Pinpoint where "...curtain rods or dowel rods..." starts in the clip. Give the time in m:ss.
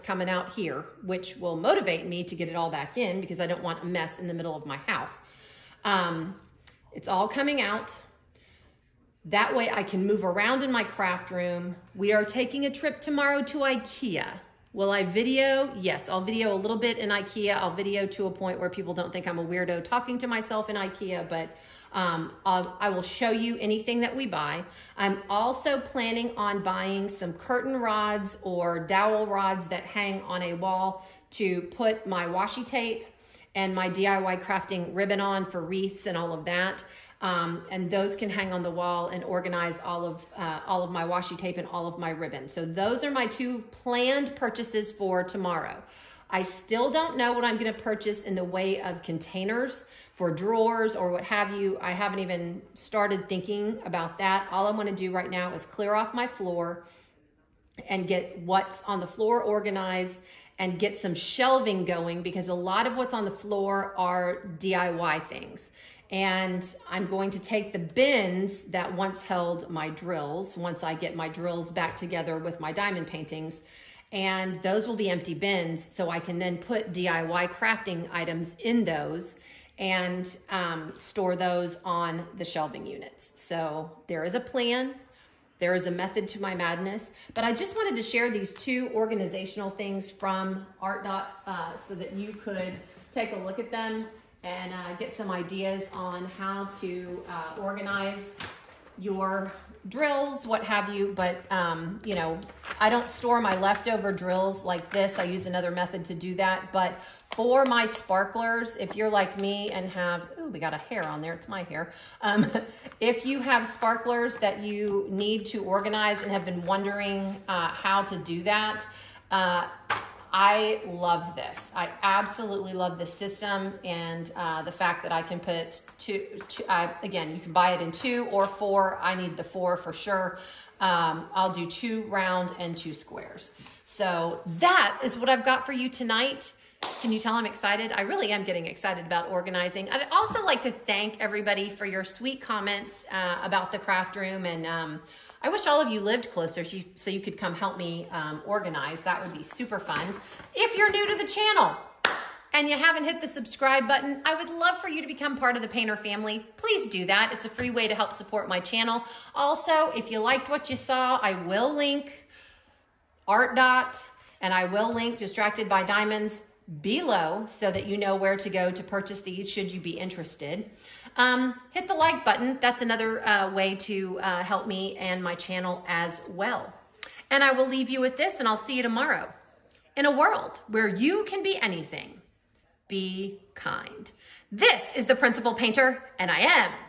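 0:27.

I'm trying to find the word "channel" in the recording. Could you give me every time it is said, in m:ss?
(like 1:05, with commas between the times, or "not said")
2:31, 2:38, 2:55.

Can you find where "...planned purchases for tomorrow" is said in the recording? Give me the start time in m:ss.
0:43.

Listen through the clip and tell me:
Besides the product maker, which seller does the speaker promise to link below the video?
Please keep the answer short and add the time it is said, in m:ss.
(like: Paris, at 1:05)
Distracted by Diamonds, at 2:45.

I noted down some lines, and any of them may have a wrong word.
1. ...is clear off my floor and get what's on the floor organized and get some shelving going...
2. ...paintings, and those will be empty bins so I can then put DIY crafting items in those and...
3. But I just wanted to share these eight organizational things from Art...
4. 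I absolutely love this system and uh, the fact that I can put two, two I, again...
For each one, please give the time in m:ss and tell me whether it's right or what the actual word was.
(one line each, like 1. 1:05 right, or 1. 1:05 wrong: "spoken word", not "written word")
1. 0:55 right
2. 1:13 right
3. 1:27 wrong: "two", not "eight"
4. 2:01 right.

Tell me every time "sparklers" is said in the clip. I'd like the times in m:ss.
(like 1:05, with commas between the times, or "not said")
1:47, 1:53.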